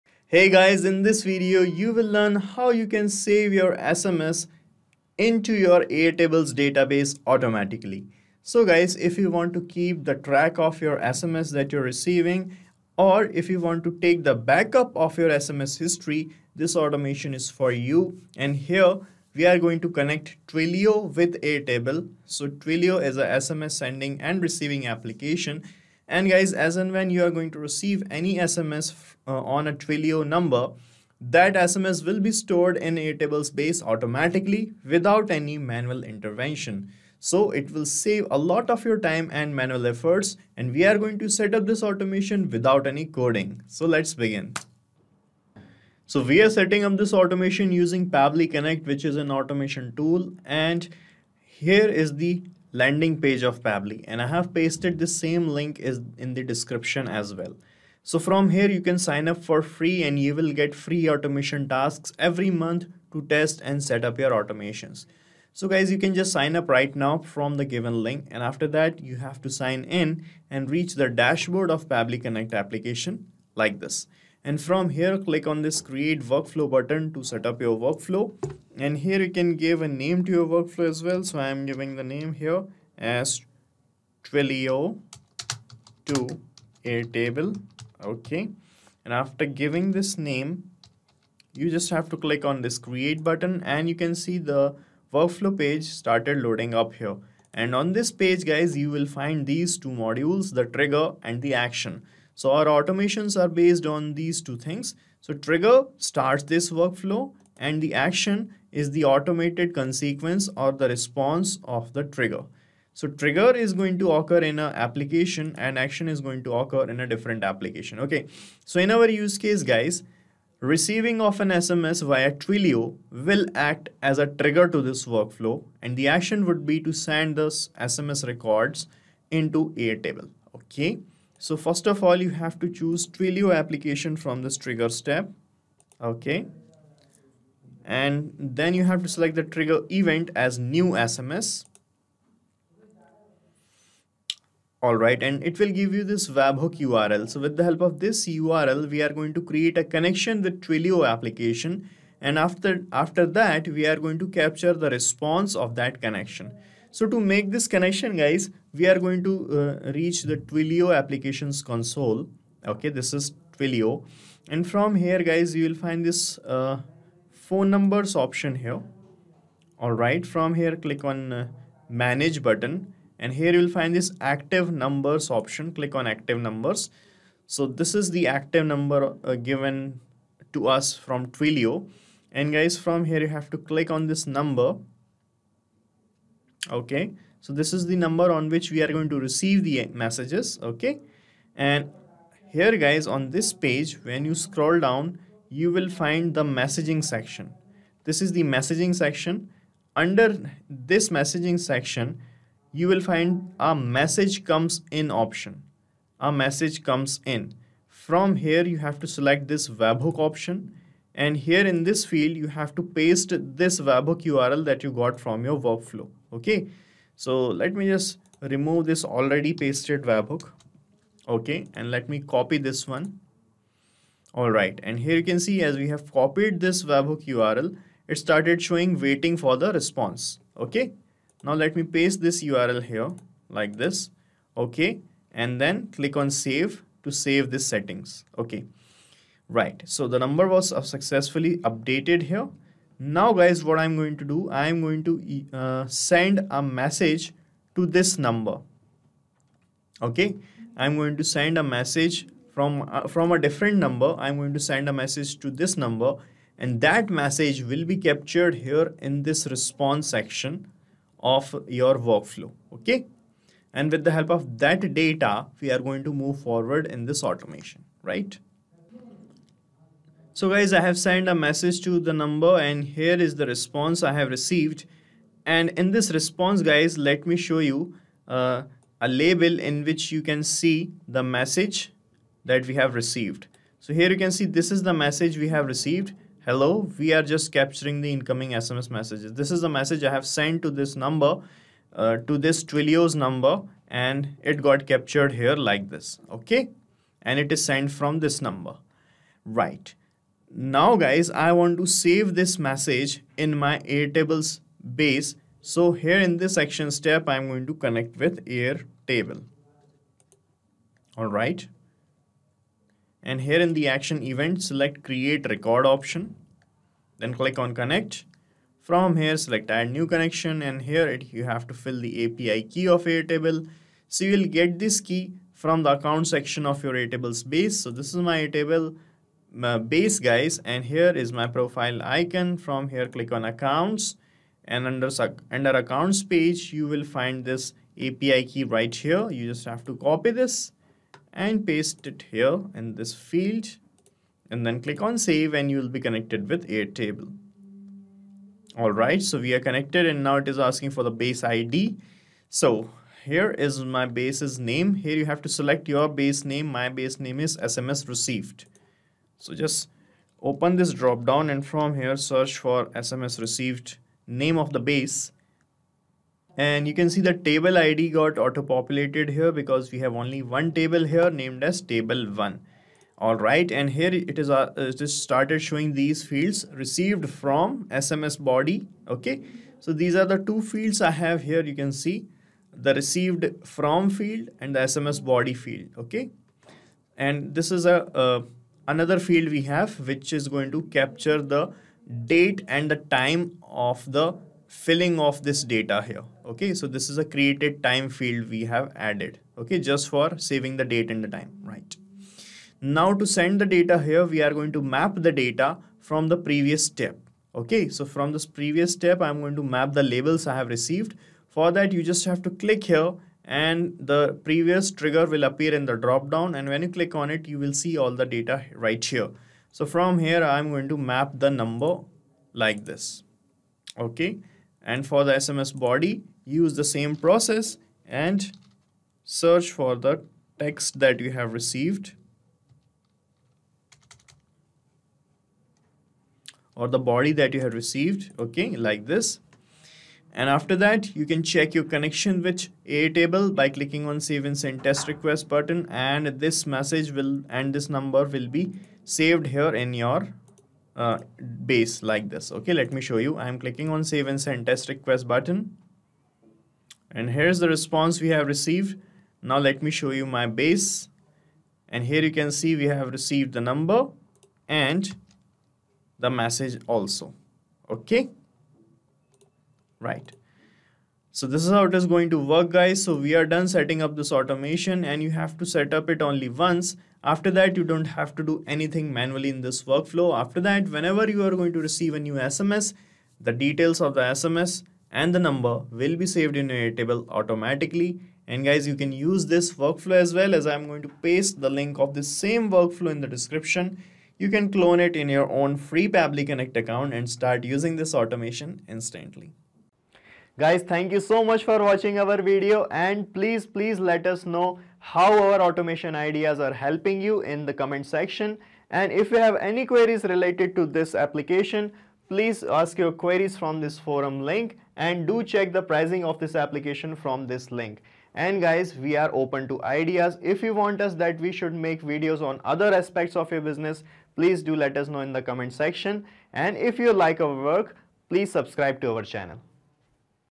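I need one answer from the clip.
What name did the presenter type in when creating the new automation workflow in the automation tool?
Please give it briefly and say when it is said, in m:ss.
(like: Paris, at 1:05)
Twilio to Airtable, at 1:24.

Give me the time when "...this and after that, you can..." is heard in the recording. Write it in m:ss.
7:19.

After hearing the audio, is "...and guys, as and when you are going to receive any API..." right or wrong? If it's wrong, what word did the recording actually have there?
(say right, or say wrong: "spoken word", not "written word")
wrong: "SMS", not "API".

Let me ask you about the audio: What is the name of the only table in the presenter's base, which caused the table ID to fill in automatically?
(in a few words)
Table 1.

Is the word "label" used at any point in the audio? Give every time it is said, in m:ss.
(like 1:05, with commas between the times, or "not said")
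4:39, 6:50.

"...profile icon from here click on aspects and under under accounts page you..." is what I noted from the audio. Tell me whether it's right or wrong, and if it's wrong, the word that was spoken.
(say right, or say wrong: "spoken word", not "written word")
wrong: "accounts", not "aspects".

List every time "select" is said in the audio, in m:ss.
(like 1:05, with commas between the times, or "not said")
2:19, 3:29, 5:14, 5:19, 5:55.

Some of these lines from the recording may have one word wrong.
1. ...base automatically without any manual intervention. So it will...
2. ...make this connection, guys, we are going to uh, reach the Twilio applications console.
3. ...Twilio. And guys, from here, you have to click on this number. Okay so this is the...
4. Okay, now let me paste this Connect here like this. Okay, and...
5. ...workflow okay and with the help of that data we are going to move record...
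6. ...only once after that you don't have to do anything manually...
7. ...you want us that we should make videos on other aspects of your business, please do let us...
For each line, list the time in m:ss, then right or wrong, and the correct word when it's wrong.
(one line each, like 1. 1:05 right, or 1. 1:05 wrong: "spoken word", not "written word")
1. 0:33 right
2. 2:37 right
3. 3:01 right
4. 3:50 wrong: "URL", not "Connect"
5. 4:21 wrong: "forward", not "record"
6. 7:56 right
7. 8:40 right.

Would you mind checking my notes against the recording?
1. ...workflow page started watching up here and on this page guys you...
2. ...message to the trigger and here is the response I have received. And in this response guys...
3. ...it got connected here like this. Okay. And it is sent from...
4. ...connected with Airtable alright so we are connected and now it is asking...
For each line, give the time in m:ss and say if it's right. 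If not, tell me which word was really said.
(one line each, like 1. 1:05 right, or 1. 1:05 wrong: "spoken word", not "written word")
1. 1:35 wrong: "loading", not "watching"
2. 4:31 wrong: "number", not "trigger"
3. 4:54 wrong: "captured", not "connected"
4. 5:45 right.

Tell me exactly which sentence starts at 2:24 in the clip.
Alright, and it will give you this webhook URL.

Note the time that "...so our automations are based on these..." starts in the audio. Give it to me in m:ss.
1:42.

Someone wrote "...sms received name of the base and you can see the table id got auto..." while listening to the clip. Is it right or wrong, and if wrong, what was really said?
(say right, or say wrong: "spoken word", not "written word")
right.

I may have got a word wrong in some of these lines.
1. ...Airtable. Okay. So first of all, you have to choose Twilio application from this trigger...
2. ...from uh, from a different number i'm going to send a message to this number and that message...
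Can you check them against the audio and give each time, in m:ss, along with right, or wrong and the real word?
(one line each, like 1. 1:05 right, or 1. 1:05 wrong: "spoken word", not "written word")
1. 2:09 right
2. 4:12 right.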